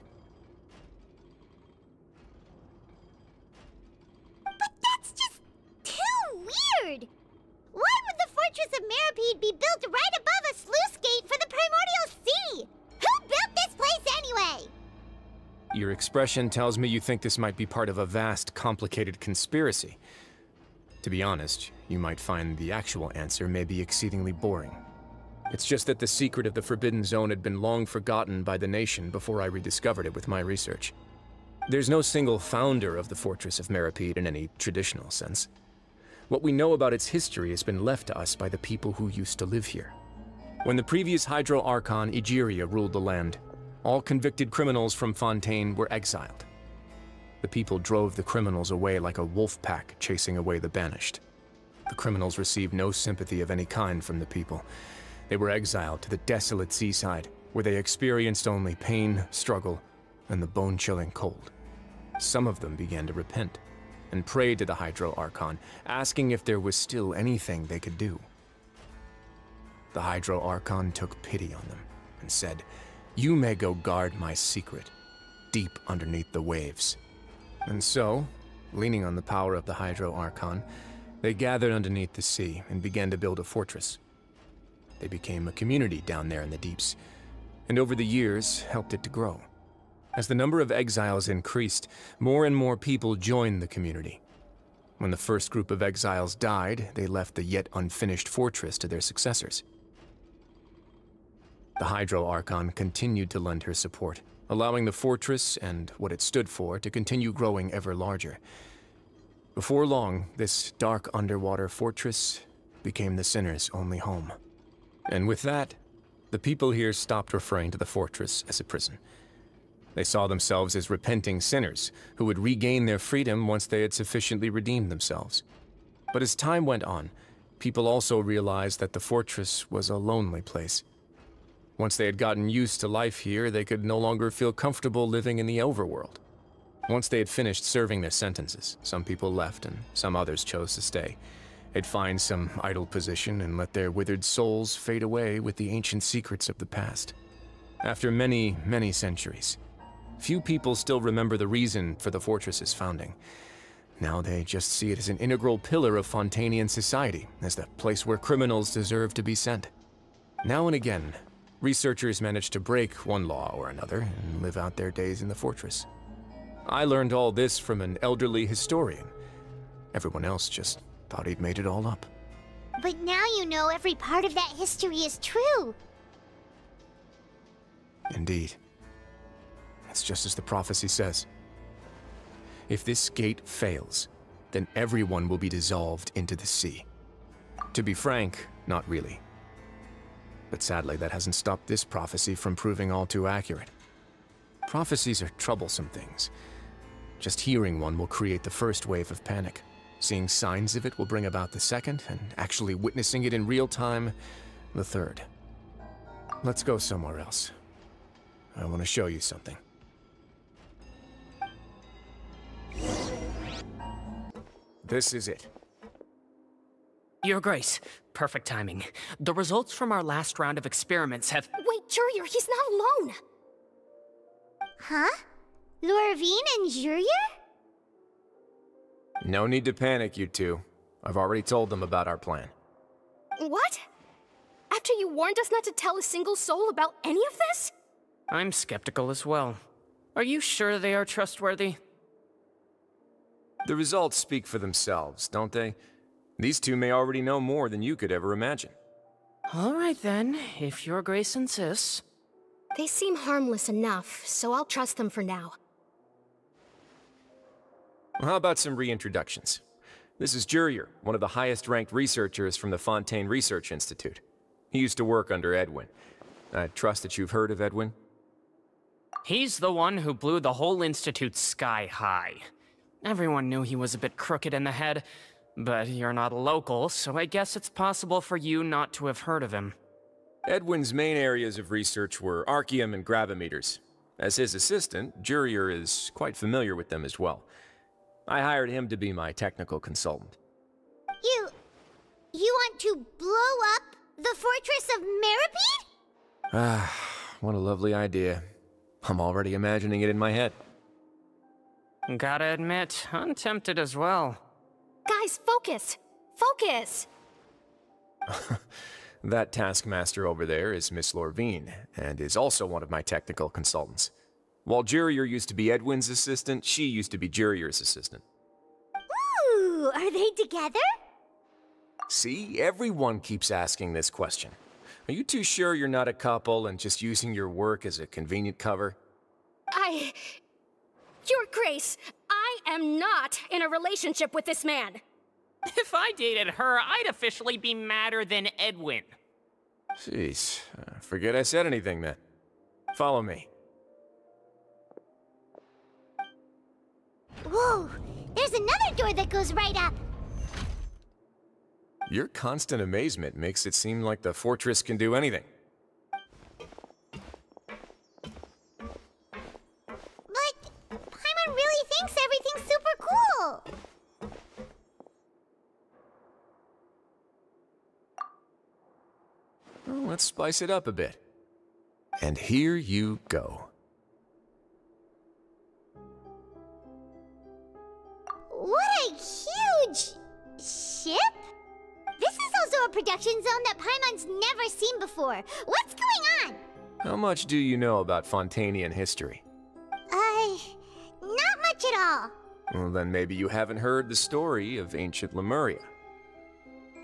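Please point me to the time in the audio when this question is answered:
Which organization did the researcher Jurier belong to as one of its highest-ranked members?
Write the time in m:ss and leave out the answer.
4:22.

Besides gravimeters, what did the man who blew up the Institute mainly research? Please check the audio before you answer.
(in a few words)
Arkhium.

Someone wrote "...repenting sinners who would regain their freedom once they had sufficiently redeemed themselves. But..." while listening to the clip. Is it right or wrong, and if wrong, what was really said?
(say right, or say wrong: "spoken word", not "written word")
right.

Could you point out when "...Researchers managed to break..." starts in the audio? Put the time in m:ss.
2:41.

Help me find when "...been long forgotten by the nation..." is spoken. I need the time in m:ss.
0:27.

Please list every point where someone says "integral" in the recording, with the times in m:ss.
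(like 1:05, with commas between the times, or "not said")
2:35.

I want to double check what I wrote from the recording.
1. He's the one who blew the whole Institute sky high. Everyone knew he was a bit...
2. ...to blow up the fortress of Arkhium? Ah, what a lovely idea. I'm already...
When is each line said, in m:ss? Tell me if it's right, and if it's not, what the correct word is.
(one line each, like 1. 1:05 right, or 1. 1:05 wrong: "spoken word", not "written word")
1. 4:29 right
2. 4:52 wrong: "Meropide", not "Arkhium".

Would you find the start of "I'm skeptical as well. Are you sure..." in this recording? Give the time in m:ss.
3:58.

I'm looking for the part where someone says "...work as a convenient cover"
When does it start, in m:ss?
5:27.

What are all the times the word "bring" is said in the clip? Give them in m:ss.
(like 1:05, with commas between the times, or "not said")
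3:21.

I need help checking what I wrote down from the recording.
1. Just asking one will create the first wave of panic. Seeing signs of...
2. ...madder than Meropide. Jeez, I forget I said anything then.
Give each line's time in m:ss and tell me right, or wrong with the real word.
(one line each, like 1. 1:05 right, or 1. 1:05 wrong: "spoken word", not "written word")
1. 3:17 wrong: "hearing", not "asking"
2. 5:37 wrong: "Edwin", not "Meropide".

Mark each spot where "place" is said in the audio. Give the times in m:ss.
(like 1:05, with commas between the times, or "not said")
2:10, 2:37.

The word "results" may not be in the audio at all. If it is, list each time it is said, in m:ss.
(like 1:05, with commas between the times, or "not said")
3:39, 4:03.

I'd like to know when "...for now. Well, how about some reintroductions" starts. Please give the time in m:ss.
4:15.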